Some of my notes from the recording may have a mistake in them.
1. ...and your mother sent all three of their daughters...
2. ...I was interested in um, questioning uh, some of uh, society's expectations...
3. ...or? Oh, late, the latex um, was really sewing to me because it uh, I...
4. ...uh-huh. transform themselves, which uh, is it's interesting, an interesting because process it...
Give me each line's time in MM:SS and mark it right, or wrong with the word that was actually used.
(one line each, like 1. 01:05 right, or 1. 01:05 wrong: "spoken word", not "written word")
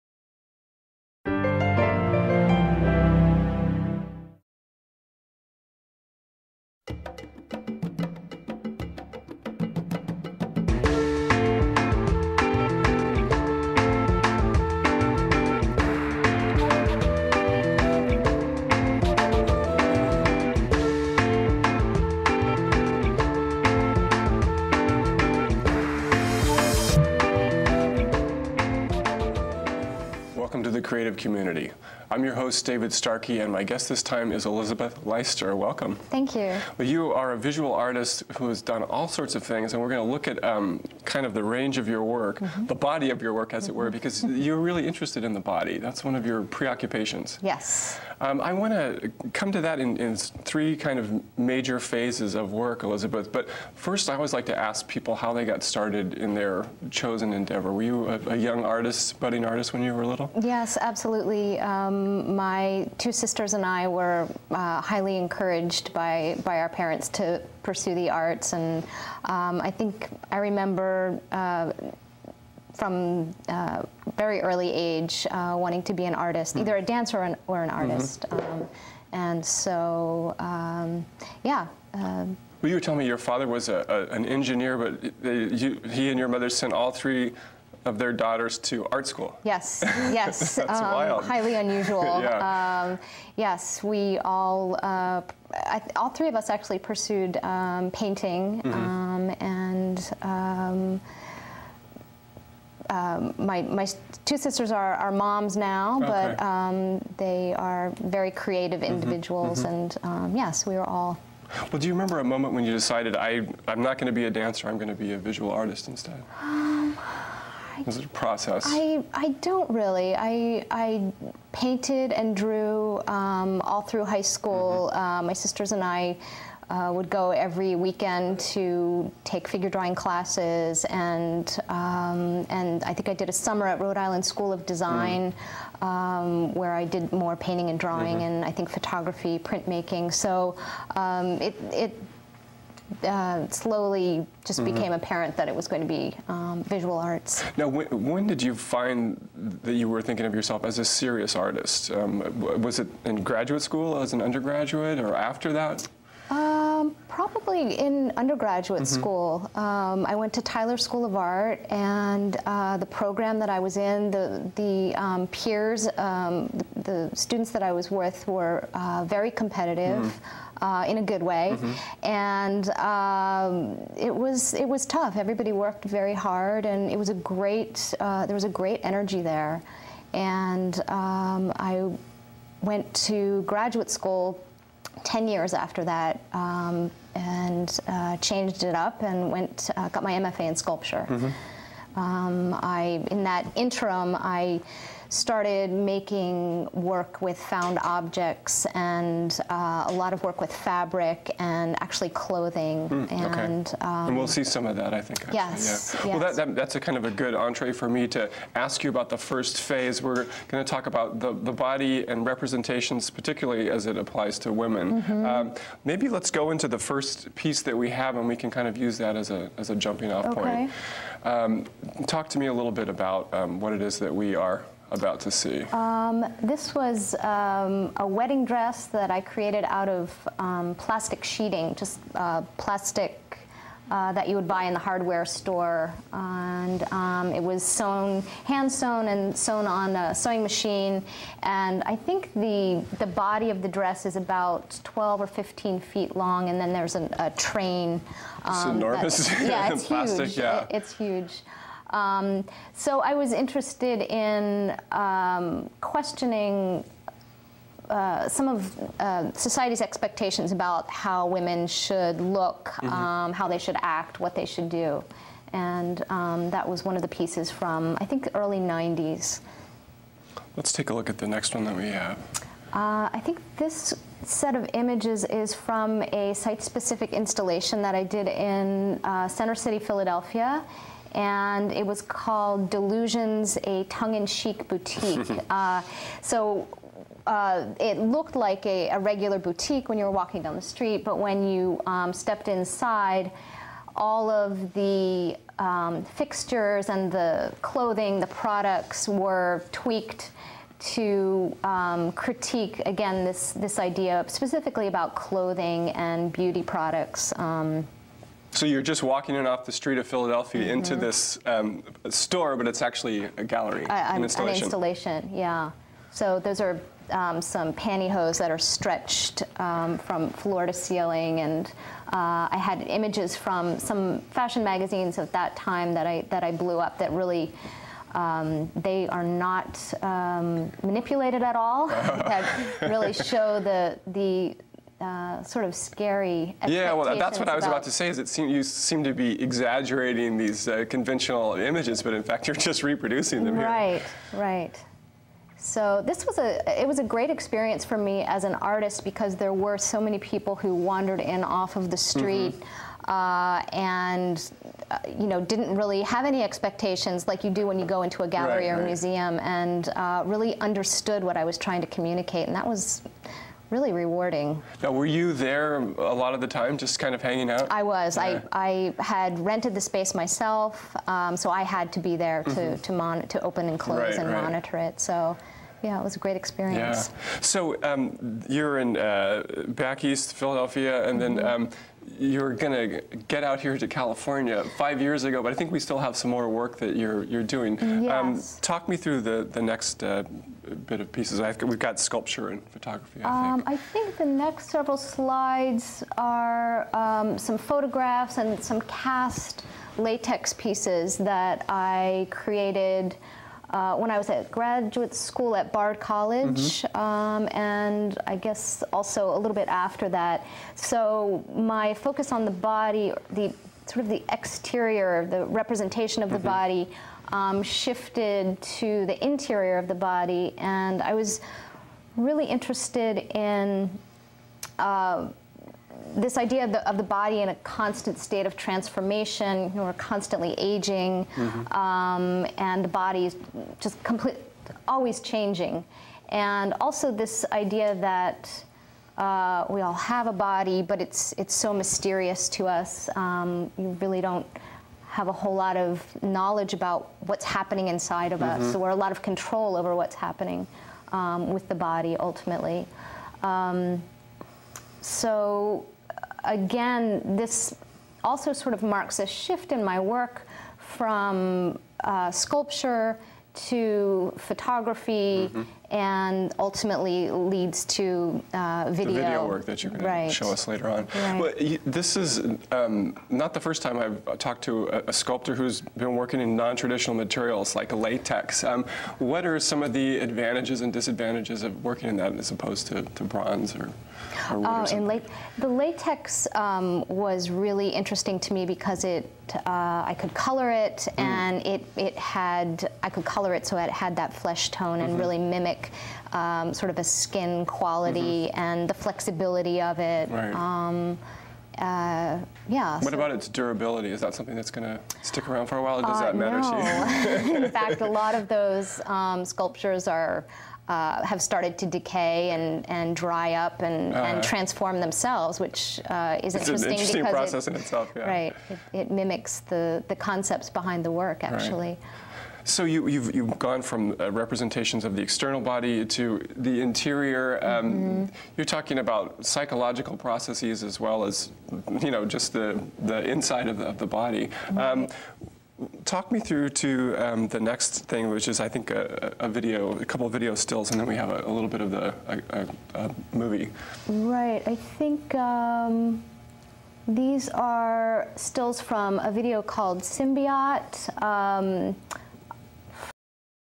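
1. 01:26 right
2. 04:13 right
3. 08:03 wrong: "interesting", not "sewing"
4. 08:34 right.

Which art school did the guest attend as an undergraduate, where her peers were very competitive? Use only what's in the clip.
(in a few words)
Tyler School of Art.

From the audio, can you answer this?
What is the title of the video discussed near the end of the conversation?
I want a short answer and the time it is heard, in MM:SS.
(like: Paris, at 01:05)
Symbiote, at 09:09.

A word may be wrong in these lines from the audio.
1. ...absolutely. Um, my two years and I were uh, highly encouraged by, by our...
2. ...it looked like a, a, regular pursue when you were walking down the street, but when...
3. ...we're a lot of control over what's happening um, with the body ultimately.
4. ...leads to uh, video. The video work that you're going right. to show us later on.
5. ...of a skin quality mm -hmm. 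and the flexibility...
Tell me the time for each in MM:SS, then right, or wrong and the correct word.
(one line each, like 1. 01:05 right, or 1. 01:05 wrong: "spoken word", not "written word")
1. 01:00 wrong: "sisters", not "years"
2. 04:47 wrong: "boutique", not "pursue"
3. 07:28 right
4. 07:47 right
5. 08:16 right.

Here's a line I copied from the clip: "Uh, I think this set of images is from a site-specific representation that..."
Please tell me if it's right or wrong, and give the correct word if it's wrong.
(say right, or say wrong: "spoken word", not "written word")
wrong: "installation", not "representation".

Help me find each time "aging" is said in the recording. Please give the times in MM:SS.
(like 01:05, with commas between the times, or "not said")
07:10.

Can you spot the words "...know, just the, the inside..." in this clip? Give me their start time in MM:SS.
08:52.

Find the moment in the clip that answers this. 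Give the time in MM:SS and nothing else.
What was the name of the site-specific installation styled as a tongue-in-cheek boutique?
04:42.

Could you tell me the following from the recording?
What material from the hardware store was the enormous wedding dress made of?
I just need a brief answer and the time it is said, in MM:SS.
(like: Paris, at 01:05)
Plastic sheeting, at 03:50.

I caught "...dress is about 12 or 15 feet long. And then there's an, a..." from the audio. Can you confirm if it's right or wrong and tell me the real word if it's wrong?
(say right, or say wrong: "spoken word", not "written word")
right.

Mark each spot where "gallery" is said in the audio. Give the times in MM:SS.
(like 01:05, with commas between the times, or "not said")
05:13, 05:58.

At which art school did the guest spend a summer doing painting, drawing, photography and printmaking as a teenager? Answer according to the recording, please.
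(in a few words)
Rhode Island School of Design.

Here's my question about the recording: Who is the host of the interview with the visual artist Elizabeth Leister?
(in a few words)
David Starkey.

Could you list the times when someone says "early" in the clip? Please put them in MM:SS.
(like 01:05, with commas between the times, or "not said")
01:14, 04:28.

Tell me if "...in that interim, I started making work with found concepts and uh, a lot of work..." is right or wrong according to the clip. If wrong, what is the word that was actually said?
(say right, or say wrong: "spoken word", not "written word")
wrong: "objects", not "concepts".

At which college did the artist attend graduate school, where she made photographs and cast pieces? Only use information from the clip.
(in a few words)
Bard College.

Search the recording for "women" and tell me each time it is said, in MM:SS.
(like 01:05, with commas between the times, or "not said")
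03:34, 04:21.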